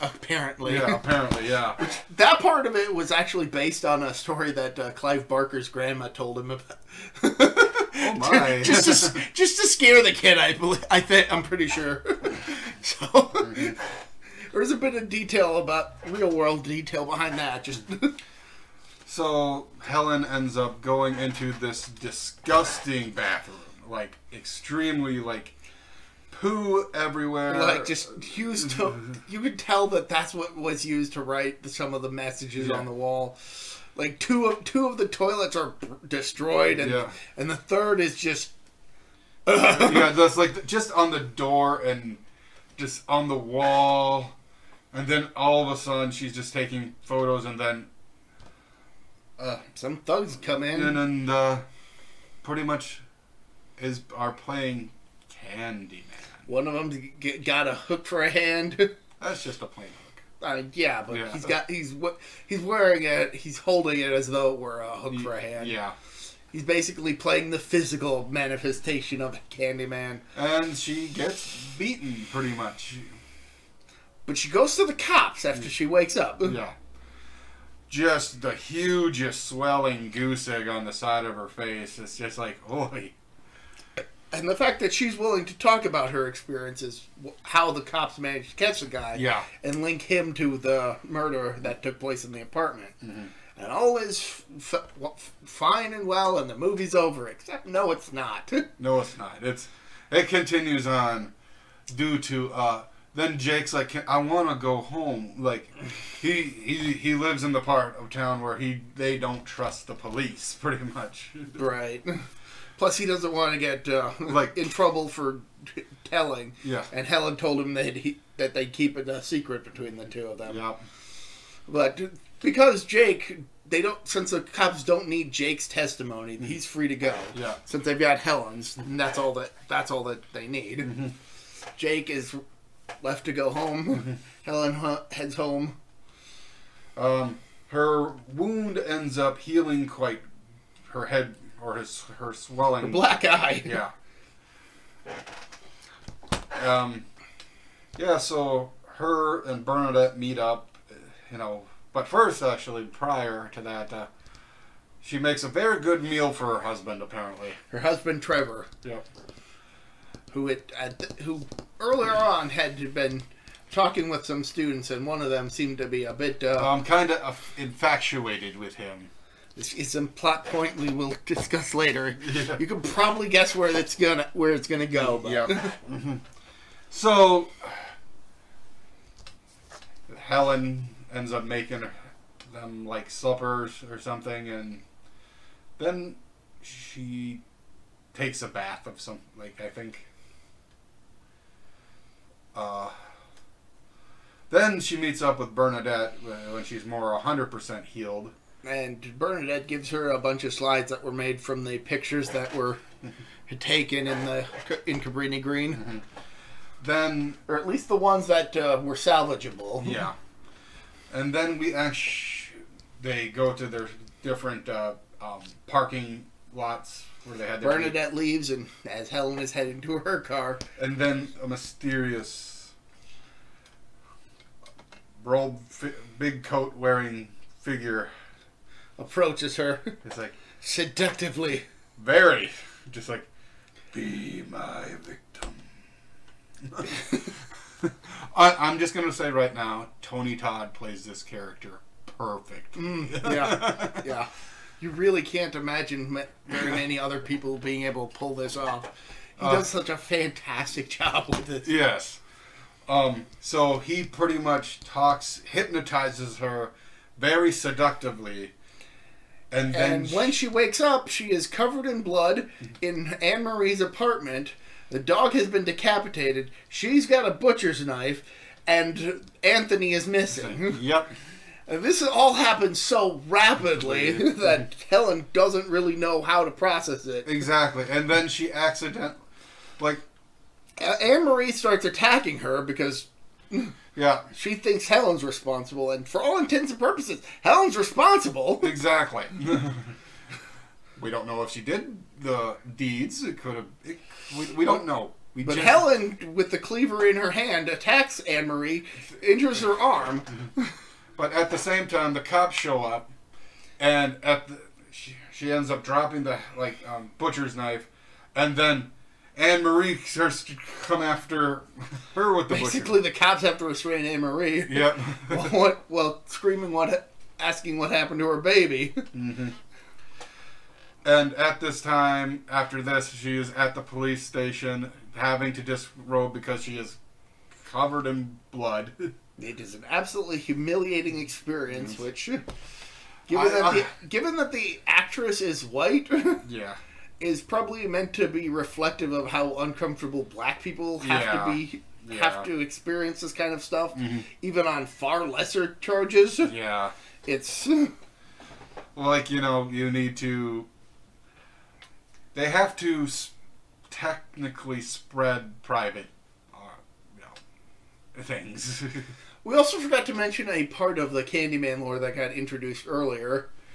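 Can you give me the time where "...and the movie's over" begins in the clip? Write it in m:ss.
1:36.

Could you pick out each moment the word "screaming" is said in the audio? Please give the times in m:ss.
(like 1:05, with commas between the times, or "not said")
5:16.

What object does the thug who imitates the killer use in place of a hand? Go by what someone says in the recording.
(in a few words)
A plain hook.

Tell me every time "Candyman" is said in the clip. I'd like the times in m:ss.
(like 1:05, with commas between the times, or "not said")
0:55, 1:09, 6:01.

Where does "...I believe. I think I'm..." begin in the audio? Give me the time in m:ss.
0:10.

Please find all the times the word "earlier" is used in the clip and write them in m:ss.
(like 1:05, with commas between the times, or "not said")
2:41, 6:02.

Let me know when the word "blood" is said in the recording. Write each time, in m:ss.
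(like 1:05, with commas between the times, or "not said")
4:22, 5:28.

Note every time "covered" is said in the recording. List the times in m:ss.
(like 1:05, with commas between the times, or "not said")
4:21, 5:27.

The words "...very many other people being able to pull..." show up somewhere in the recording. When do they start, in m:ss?
4:06.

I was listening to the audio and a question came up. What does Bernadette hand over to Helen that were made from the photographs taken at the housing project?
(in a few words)
Slides.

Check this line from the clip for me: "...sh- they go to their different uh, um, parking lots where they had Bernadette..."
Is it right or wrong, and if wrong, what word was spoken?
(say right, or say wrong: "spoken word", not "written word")
right.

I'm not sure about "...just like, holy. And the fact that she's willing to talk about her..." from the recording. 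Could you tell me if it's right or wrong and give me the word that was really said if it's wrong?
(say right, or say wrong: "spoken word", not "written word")
right.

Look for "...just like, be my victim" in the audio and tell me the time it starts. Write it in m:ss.
3:52.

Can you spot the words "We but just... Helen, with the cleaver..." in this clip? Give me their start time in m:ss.
4:55.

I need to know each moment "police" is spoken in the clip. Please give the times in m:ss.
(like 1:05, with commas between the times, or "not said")
1:49, 5:23.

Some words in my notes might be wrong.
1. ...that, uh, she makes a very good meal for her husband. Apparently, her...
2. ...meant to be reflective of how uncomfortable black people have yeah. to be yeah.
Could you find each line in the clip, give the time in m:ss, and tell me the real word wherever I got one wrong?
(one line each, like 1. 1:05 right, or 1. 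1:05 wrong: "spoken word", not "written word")
1. 2:33 right
2. 5:37 right.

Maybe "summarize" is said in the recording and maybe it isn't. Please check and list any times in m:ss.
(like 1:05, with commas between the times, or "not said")
not said.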